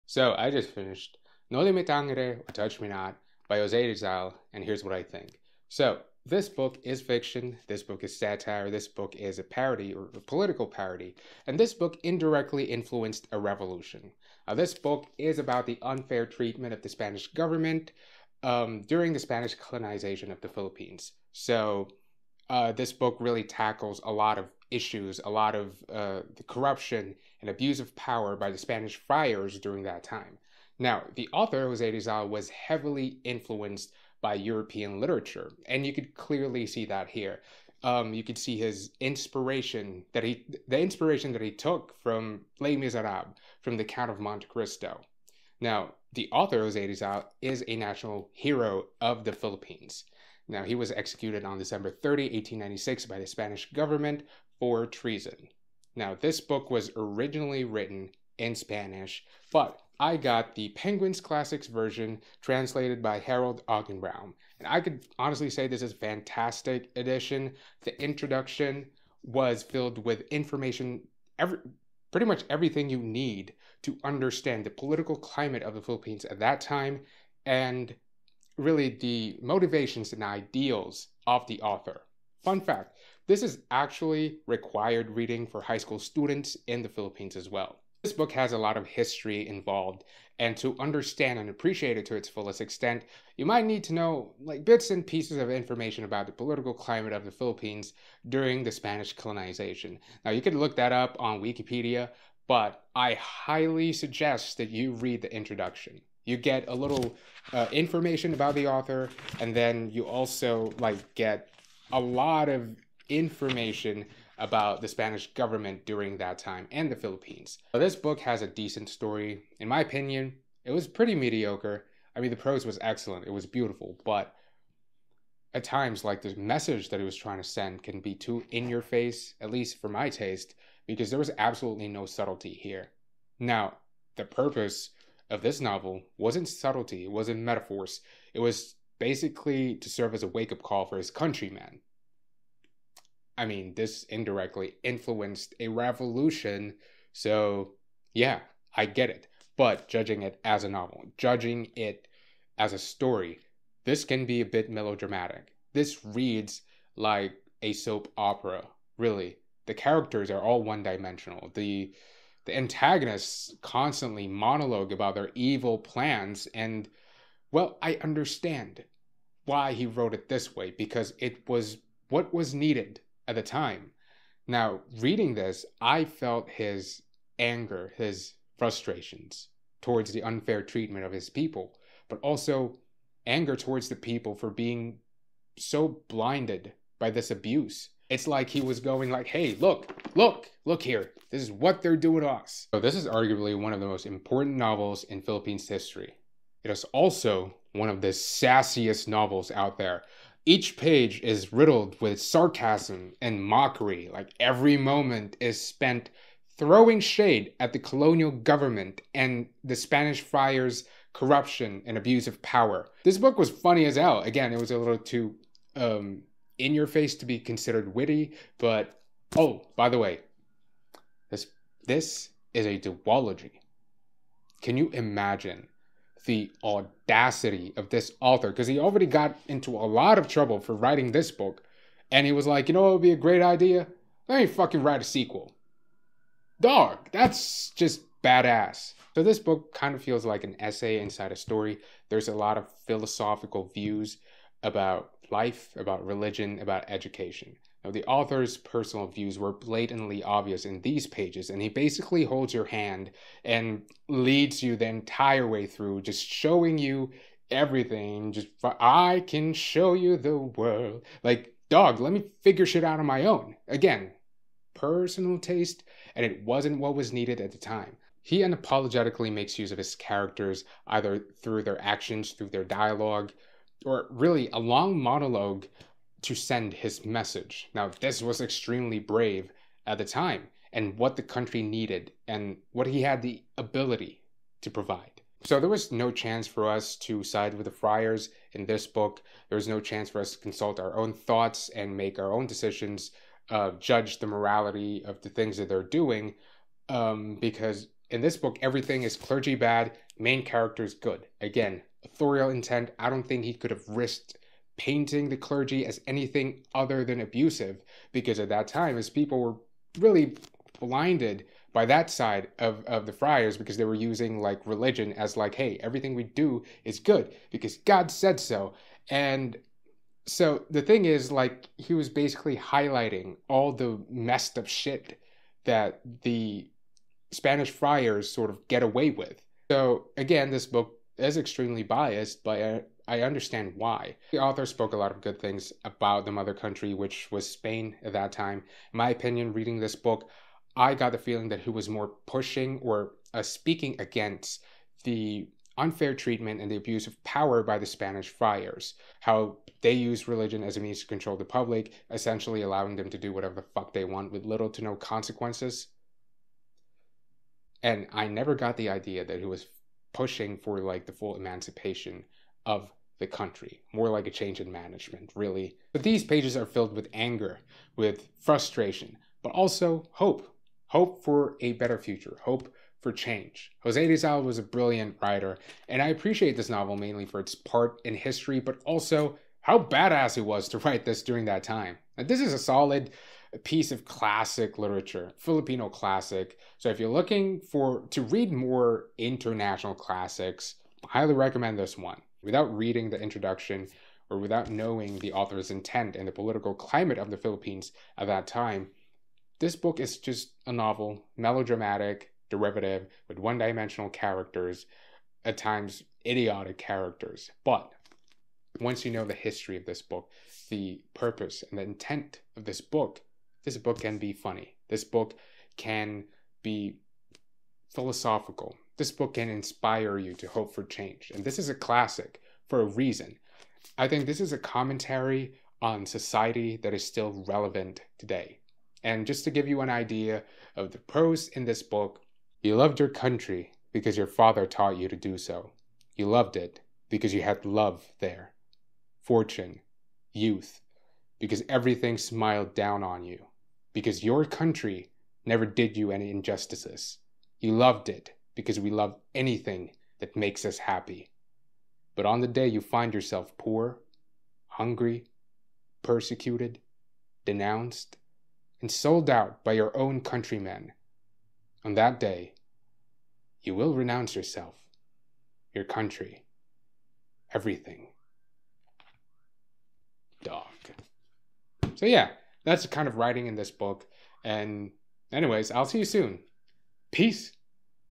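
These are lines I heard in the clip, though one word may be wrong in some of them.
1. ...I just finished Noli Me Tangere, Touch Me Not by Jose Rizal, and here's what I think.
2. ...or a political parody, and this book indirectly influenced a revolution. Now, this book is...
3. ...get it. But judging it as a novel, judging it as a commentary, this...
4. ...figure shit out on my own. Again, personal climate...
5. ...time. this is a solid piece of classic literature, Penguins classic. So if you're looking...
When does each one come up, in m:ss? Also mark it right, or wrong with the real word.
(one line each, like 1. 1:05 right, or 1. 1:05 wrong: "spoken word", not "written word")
1. 0:00 right
2. 0:09 right
3. 2:28 wrong: "story", not "commentary"
4. 4:22 wrong: "taste", not "climate"
5. 6:21 wrong: "Filipino", not "Penguins".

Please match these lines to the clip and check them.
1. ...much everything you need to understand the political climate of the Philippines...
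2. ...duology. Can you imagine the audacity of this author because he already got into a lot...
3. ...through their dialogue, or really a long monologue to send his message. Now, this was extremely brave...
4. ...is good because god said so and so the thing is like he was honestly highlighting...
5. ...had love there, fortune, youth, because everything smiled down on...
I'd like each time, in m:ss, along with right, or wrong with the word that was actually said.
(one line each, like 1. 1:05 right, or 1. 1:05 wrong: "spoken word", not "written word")
1. 1:12 right
2. 3:42 right
3. 4:32 right
4. 5:16 wrong: "basically", not "honestly"
5. 7:17 right.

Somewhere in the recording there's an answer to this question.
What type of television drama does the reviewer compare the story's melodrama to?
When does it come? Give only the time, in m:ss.
2:37.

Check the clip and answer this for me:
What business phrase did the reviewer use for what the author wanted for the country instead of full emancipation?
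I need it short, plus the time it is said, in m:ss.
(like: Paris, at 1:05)
Change in management, at 6:04.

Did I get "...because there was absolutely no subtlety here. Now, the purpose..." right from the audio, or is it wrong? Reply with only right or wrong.
right.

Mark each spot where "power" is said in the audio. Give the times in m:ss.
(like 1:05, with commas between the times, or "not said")
0:27, 3:32, 5:47.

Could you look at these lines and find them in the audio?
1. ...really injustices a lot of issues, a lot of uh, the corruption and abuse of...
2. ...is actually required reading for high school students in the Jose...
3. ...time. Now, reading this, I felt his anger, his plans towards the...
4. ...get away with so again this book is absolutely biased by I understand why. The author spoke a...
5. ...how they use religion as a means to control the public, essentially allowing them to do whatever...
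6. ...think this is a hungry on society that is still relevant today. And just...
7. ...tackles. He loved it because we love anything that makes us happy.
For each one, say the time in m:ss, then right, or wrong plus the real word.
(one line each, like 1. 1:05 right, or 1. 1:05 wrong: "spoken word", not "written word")
1. 0:23 wrong: "tackles", not "injustices"
2. 1:23 wrong: "Philippines", not "Jose"
3. 2:53 wrong: "frustrations", not "plans"
4. 5:28 wrong: "extremely", not "absolutely"
5. 5:49 right
6. 7:04 wrong: "commentary", not "hungry"
7. 7:26 wrong: "injustices", not "tackles".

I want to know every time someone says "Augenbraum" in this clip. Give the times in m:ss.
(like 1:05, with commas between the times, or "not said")
1:03.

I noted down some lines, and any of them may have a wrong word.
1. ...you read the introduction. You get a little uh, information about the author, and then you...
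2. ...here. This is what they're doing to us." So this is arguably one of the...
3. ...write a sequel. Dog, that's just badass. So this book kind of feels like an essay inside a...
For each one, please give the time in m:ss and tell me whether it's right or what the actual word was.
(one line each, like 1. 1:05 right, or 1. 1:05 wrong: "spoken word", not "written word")
1. 1:44 right
2. 3:10 right
3. 3:54 right.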